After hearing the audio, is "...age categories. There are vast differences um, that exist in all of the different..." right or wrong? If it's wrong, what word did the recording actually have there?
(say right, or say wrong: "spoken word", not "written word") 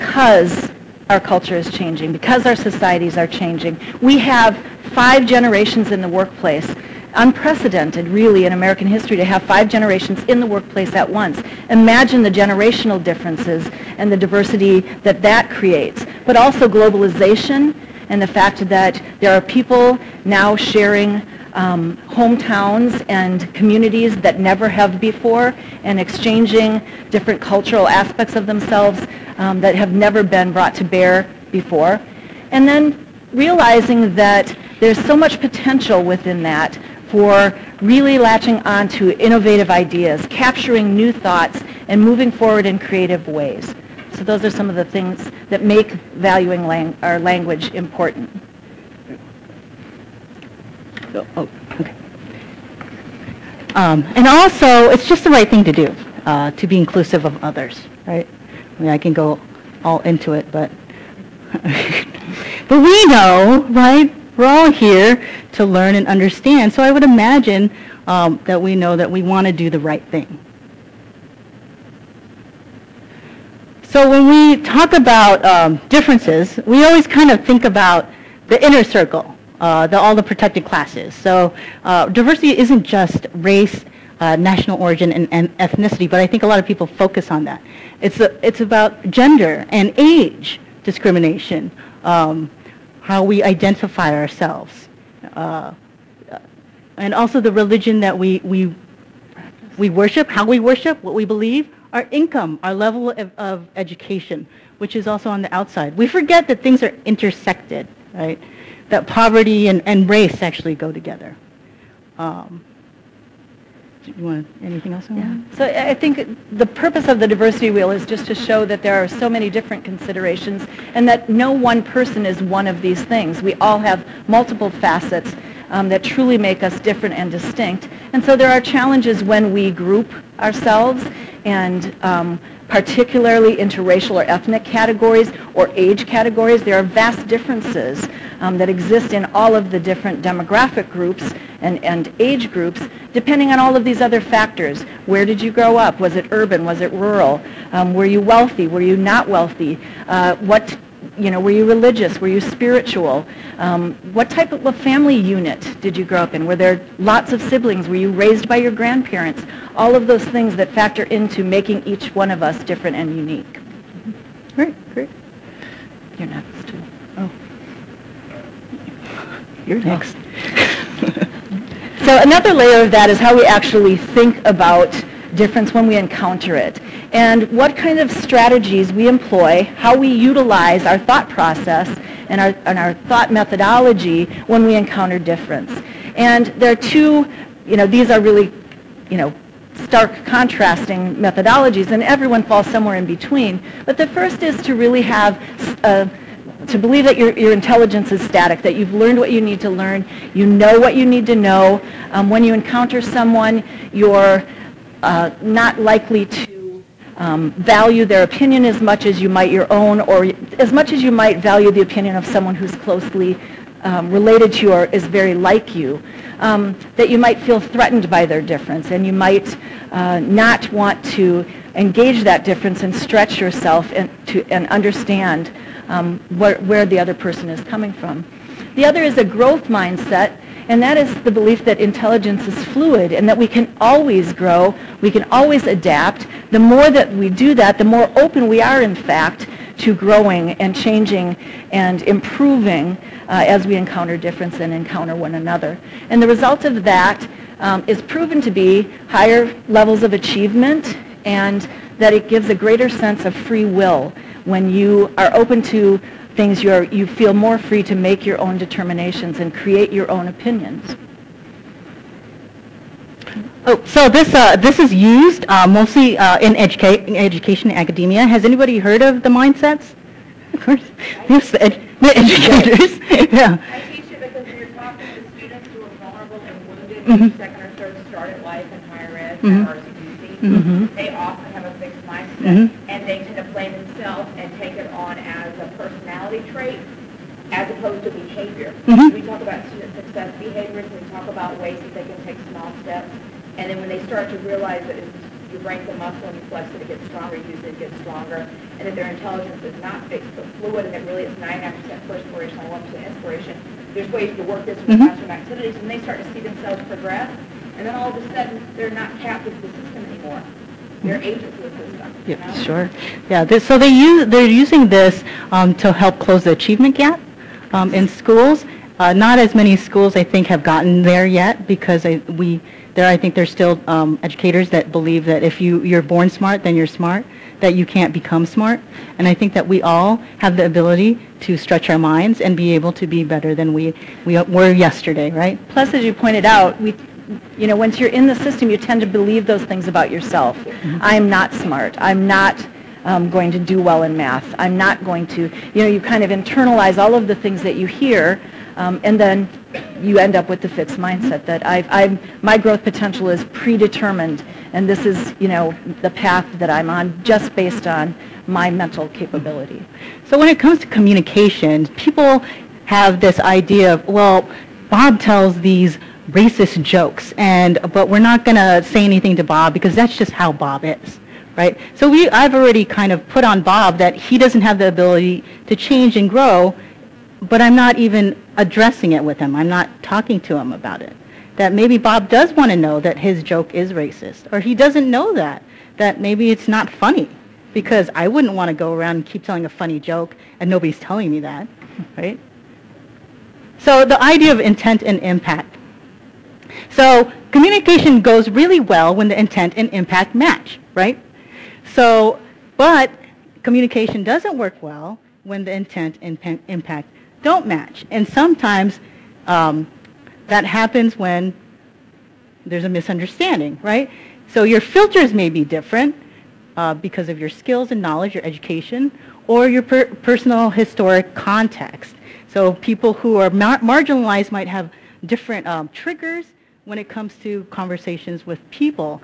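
right.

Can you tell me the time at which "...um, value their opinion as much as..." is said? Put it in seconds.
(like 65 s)
207 s.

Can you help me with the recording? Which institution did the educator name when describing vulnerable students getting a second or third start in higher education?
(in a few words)
RCTC.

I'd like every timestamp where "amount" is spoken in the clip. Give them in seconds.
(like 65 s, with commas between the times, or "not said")
not said.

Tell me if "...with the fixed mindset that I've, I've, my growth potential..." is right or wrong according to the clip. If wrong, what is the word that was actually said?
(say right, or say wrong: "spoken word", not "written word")
right.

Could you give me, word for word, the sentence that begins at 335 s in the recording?
Plus, as you pointed out, we, you know, once you're in the system, you tend to believe those things about yourself.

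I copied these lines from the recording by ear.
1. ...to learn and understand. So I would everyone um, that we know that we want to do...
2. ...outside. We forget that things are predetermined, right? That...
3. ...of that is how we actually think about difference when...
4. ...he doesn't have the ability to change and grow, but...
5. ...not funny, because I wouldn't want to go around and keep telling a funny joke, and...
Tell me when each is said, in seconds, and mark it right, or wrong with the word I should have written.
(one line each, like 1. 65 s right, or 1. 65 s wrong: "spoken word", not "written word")
1. 65 s wrong: "imagine", not "everyone"
2. 105 s wrong: "intersected", not "predetermined"
3. 172 s right
4. 374 s right
5. 386 s right.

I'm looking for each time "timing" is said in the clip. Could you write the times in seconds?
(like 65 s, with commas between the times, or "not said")
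not said.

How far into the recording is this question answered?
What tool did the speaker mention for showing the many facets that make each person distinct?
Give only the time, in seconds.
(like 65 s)
117 s.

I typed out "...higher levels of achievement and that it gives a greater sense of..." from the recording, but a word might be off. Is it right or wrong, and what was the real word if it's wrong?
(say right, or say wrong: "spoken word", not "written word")
right.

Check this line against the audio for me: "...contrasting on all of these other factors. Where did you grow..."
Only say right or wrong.
wrong.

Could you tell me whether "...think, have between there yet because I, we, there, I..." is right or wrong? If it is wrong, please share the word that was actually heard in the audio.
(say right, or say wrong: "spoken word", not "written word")
wrong: "gotten", not "between".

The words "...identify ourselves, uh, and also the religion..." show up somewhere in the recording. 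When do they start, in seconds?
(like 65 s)
93 s.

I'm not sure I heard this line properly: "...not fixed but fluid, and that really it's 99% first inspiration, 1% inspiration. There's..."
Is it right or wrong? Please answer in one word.
right.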